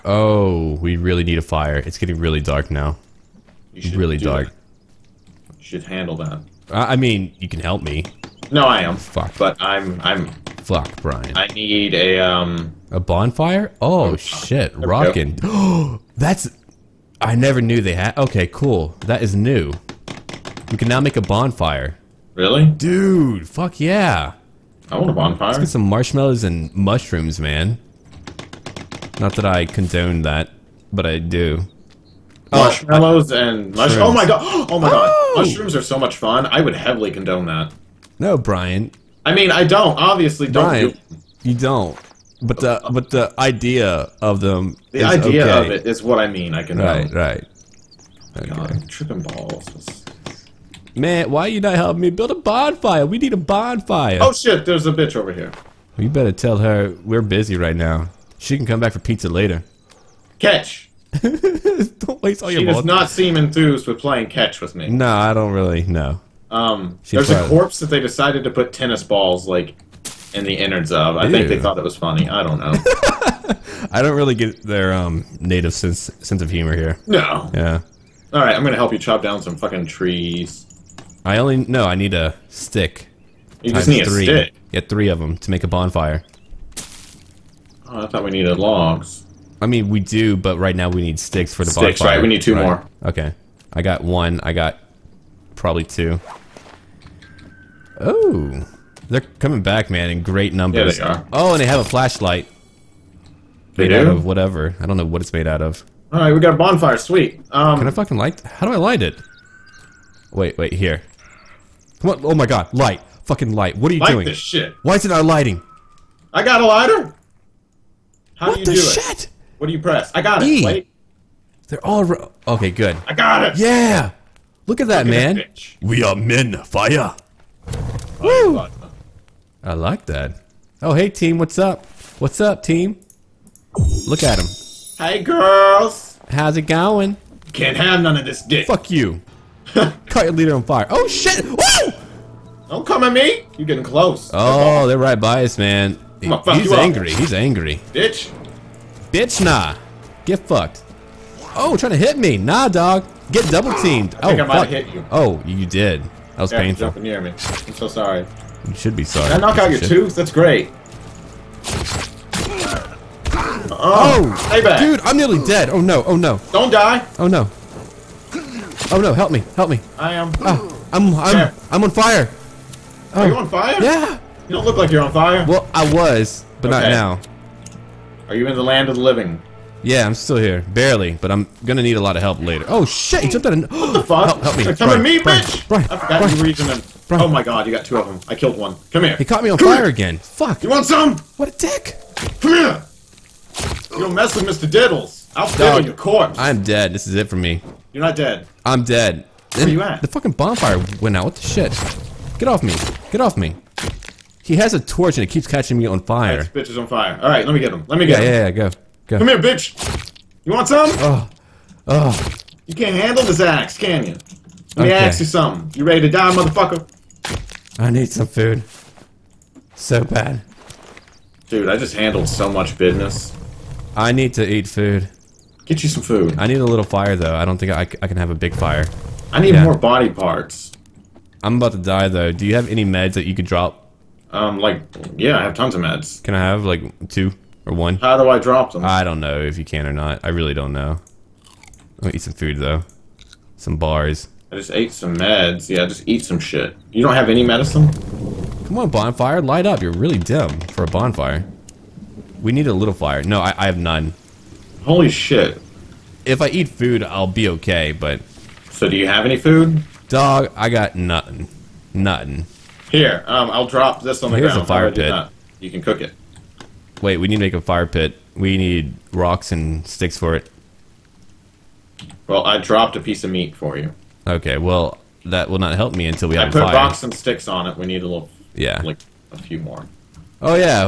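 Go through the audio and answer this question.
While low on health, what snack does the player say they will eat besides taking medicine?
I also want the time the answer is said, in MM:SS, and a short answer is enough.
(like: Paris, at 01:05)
Bars, at 04:03.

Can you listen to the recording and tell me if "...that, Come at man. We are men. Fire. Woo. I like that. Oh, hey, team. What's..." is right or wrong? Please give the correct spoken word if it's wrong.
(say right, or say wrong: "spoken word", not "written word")
wrong: "Look", not "Come".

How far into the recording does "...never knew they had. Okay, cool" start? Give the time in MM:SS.
00:17.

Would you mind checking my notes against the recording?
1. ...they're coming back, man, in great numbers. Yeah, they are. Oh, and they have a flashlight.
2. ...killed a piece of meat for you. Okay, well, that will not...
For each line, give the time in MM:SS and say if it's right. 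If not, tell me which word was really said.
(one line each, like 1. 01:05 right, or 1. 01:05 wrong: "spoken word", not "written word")
1. 01:39 right
2. 04:32 wrong: "dropped", not "killed".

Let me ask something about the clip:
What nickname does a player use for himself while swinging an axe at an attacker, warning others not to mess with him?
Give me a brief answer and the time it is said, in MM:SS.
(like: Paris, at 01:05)
Mr. Diddles, at 03:14.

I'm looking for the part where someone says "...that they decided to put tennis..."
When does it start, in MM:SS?
01:07.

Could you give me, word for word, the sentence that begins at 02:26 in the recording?
I'm gonna fuck he's you angry.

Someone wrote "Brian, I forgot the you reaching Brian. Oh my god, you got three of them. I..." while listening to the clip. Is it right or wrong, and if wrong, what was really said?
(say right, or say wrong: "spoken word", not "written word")
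wrong: "two", not "three".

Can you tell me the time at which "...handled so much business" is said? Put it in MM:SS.
03:41.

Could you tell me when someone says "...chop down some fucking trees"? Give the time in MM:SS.
01:18.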